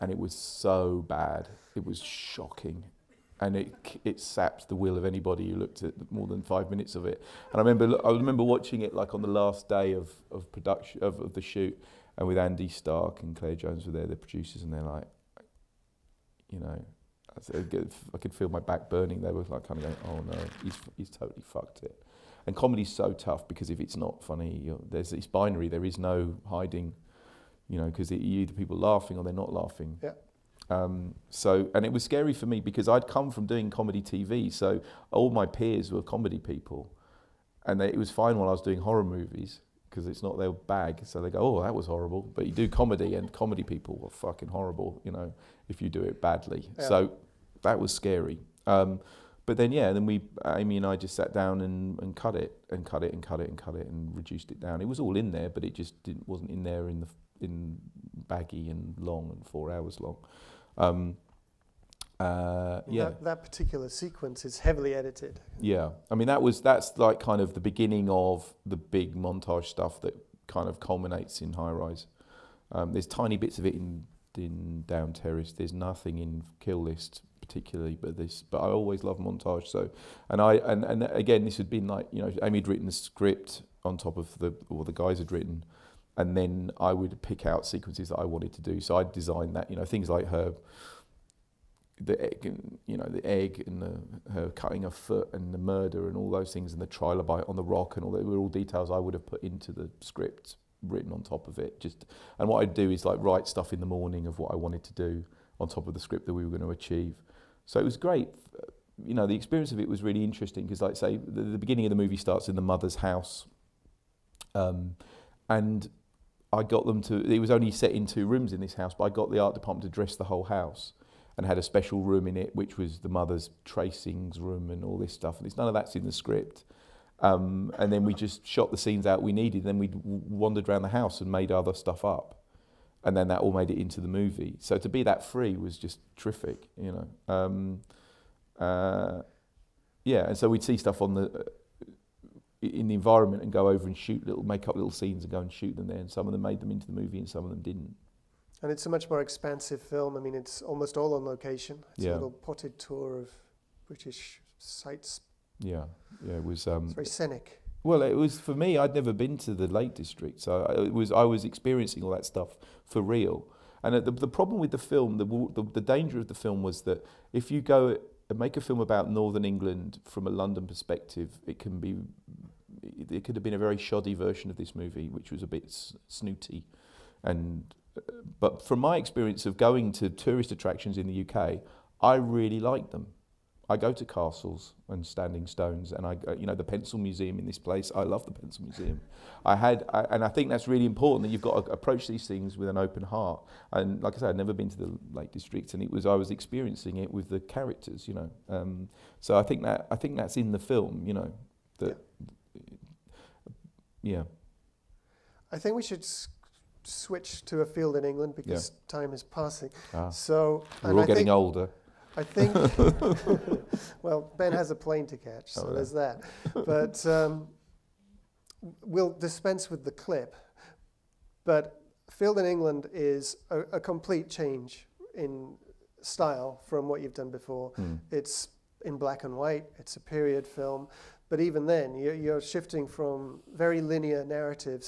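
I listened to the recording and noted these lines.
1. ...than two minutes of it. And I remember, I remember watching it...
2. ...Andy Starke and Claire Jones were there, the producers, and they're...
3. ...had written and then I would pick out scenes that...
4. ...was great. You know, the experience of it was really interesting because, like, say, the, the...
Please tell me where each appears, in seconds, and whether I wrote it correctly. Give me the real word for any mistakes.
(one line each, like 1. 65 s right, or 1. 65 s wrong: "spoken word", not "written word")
1. 6 s wrong: "five", not "two"
2. 12 s right
3. 85 s wrong: "sequences", not "scenes"
4. 107 s right.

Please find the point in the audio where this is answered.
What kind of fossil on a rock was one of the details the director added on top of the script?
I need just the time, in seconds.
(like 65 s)
96 s.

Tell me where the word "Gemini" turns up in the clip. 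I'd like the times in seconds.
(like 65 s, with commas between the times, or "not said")
not said.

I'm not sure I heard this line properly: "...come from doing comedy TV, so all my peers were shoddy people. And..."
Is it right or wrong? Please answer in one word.
wrong.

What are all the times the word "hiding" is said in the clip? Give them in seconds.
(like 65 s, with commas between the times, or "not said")
26 s.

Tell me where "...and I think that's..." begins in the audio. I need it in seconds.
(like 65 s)
190 s.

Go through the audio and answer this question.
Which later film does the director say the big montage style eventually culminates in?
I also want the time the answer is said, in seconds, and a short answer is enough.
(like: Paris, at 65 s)
High Rise, at 71 s.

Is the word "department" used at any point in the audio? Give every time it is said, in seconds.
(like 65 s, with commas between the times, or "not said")
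119 s.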